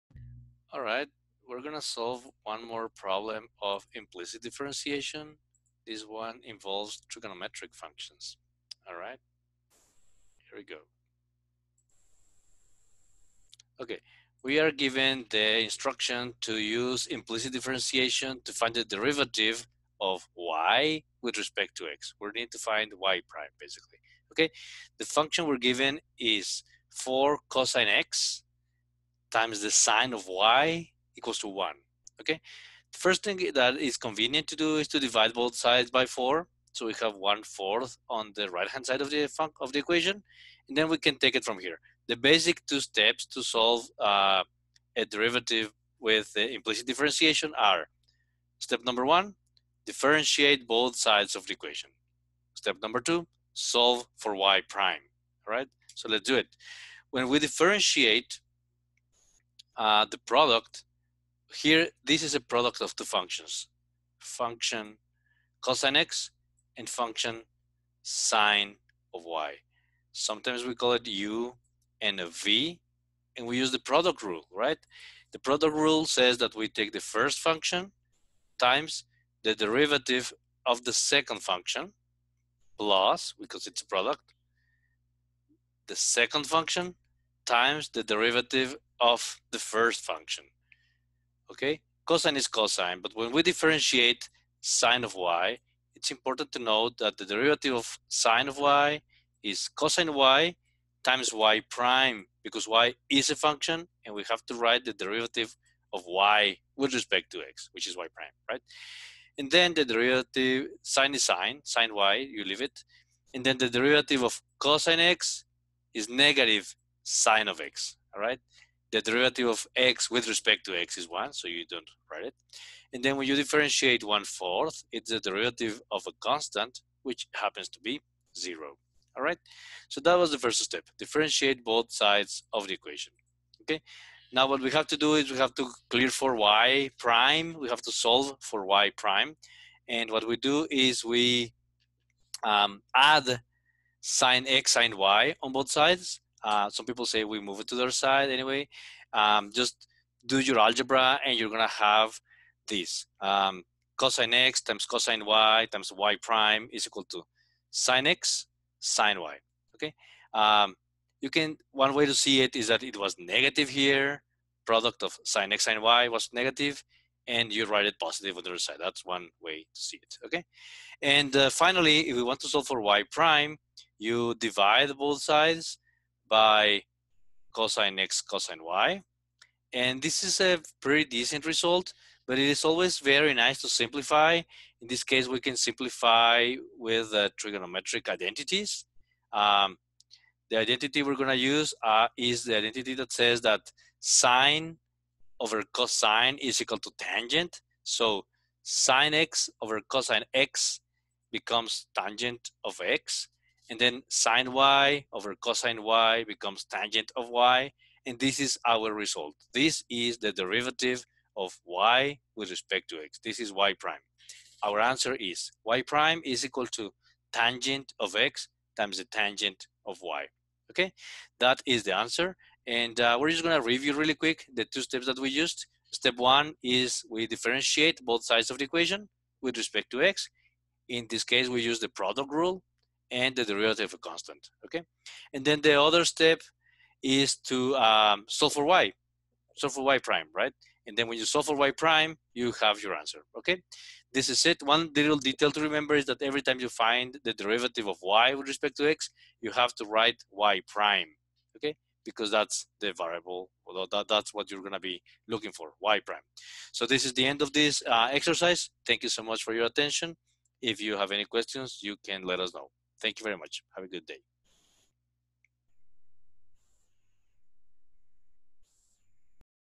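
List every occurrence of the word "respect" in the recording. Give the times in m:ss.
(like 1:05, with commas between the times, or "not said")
0:21, 1:46, 2:00, 3:32, 3:49, 4:08.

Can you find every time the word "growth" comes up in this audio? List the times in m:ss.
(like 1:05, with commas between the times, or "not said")
not said.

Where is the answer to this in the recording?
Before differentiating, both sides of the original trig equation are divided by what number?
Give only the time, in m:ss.
0:34.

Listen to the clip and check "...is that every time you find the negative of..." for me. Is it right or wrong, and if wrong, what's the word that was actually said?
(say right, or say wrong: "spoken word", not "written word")
wrong: "derivative", not "negative".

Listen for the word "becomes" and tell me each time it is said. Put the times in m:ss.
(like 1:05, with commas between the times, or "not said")
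3:21, 3:26.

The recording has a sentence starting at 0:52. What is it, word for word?
Step number two, solve for y prime, Right.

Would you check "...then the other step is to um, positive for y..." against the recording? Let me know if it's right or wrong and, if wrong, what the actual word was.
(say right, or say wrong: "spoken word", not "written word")
wrong: "solve", not "positive".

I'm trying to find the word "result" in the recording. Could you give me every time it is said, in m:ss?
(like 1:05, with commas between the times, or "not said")
3:01, 3:28.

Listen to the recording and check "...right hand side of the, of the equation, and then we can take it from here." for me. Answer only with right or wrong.
right.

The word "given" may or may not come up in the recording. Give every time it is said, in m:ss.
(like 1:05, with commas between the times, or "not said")
0:14, 0:25.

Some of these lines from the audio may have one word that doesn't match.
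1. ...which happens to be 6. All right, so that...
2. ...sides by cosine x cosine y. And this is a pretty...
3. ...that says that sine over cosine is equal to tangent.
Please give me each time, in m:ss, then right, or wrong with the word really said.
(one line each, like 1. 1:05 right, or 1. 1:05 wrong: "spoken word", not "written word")
1. 2:07 wrong: "0", not "6"
2. 2:55 right
3. 3:12 right.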